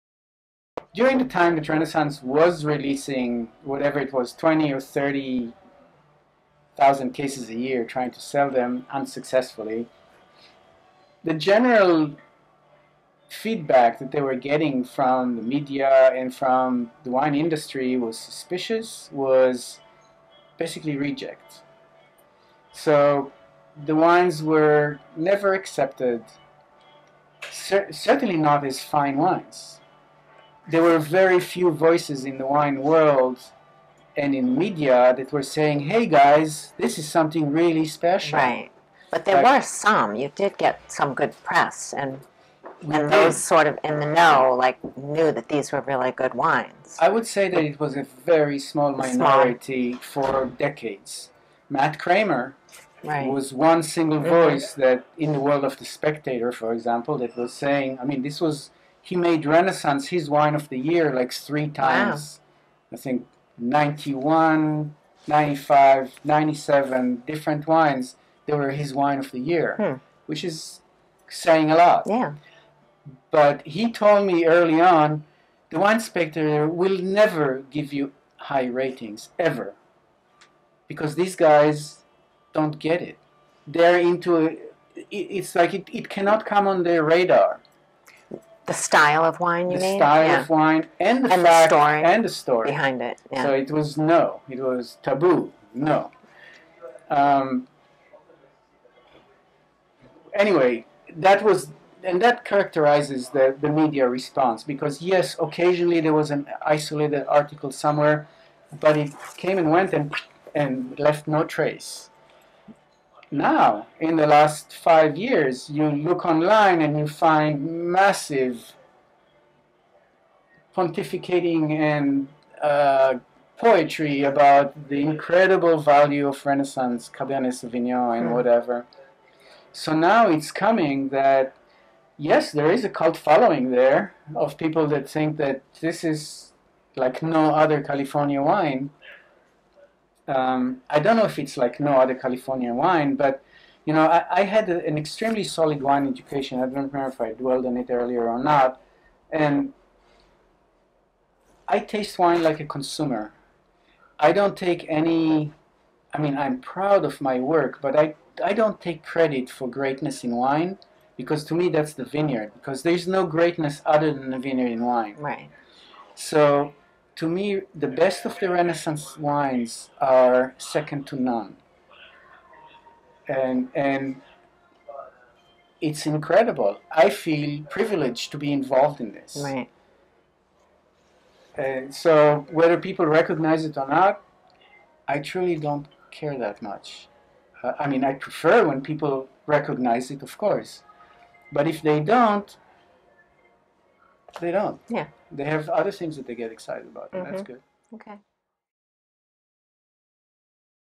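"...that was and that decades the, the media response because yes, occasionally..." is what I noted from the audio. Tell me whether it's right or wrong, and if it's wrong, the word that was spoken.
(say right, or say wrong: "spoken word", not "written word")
wrong: "characterizes", not "decades".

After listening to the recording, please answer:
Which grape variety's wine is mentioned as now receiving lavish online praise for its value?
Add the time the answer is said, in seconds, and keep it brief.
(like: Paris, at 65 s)
Cabernet Sauvignon, at 127 s.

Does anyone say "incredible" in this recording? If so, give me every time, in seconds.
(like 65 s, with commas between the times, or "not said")
125 s, 176 s.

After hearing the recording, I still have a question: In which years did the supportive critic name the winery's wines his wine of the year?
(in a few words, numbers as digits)
91, 95, 97.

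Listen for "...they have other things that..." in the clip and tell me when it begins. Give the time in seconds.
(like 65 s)
195 s.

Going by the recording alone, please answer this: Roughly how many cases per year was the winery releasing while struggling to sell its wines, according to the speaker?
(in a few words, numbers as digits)
20 or 30 thousand.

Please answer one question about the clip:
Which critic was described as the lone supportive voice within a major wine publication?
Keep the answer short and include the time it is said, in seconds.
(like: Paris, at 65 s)
Matt Kramer, at 51 s.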